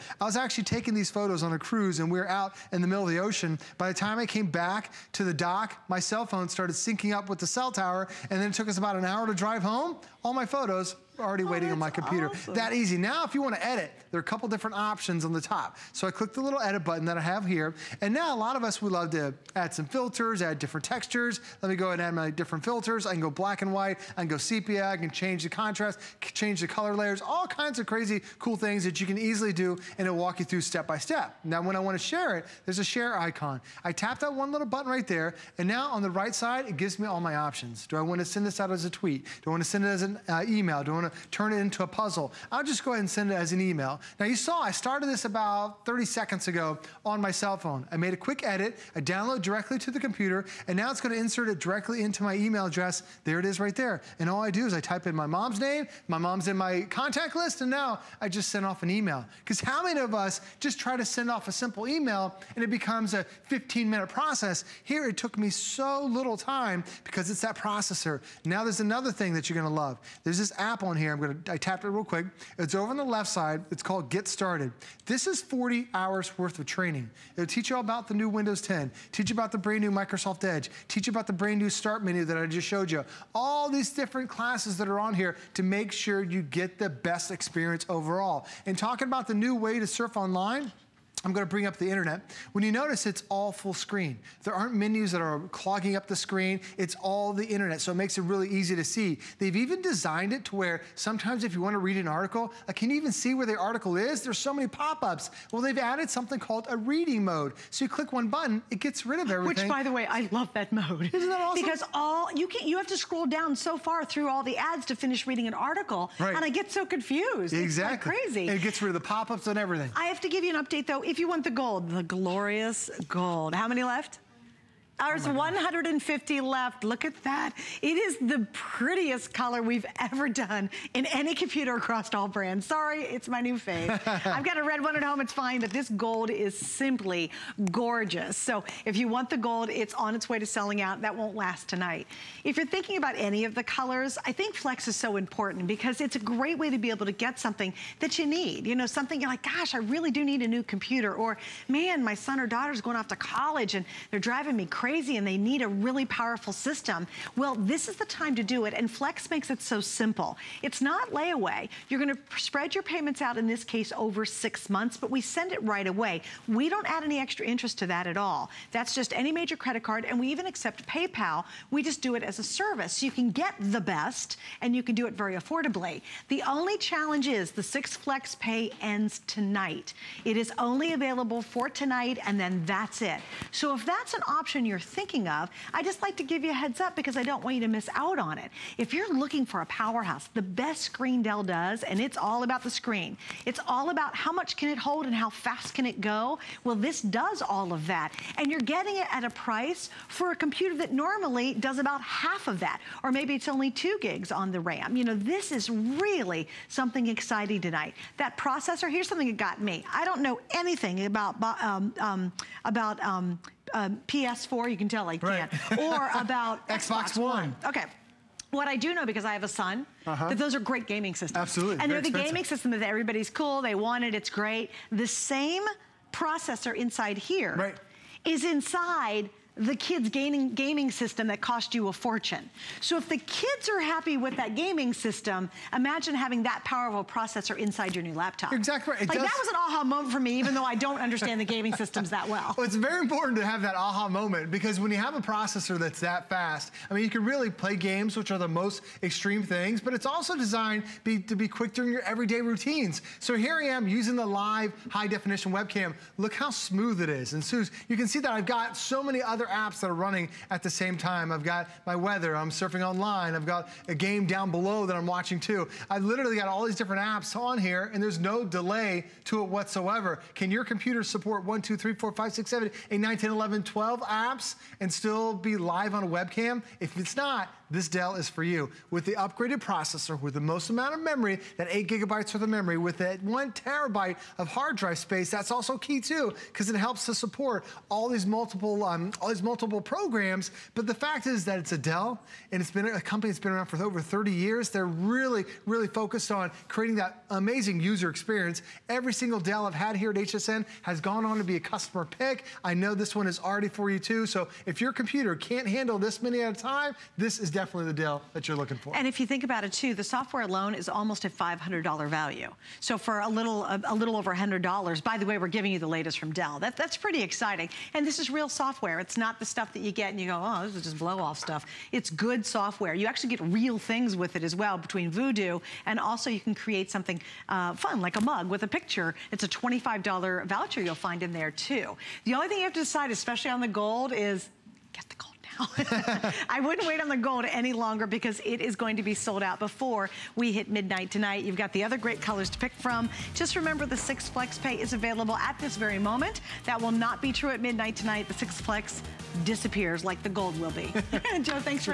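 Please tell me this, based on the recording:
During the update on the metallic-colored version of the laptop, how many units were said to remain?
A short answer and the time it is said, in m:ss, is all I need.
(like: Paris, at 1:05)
150, at 2:05.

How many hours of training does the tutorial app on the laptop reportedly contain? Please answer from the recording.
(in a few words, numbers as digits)
40.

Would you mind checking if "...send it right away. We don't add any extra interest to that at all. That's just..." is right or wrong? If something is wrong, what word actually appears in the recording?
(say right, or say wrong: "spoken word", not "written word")
right.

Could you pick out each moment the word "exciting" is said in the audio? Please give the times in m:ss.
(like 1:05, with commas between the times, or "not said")
3:27, 5:17.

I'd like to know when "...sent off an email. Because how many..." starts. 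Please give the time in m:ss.
0:58.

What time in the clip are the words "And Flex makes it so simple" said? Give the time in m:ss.
2:38.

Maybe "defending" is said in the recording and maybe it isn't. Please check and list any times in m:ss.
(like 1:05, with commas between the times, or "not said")
not said.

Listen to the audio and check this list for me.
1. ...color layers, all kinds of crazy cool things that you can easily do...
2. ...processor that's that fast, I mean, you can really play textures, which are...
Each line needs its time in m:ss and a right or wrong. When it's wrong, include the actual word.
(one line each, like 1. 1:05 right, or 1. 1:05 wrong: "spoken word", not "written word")
1. 0:26 right
2. 4:05 wrong: "games", not "textures".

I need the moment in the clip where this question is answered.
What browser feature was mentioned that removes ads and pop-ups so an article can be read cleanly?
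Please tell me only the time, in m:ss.
1:46.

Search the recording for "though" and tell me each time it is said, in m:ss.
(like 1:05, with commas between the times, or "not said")
2:00, 4:00.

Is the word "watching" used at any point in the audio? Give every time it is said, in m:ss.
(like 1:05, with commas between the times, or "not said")
4:25.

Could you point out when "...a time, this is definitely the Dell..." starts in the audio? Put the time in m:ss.
5:06.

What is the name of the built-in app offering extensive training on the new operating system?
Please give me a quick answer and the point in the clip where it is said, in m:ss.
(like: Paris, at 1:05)
Get Started, at 1:14.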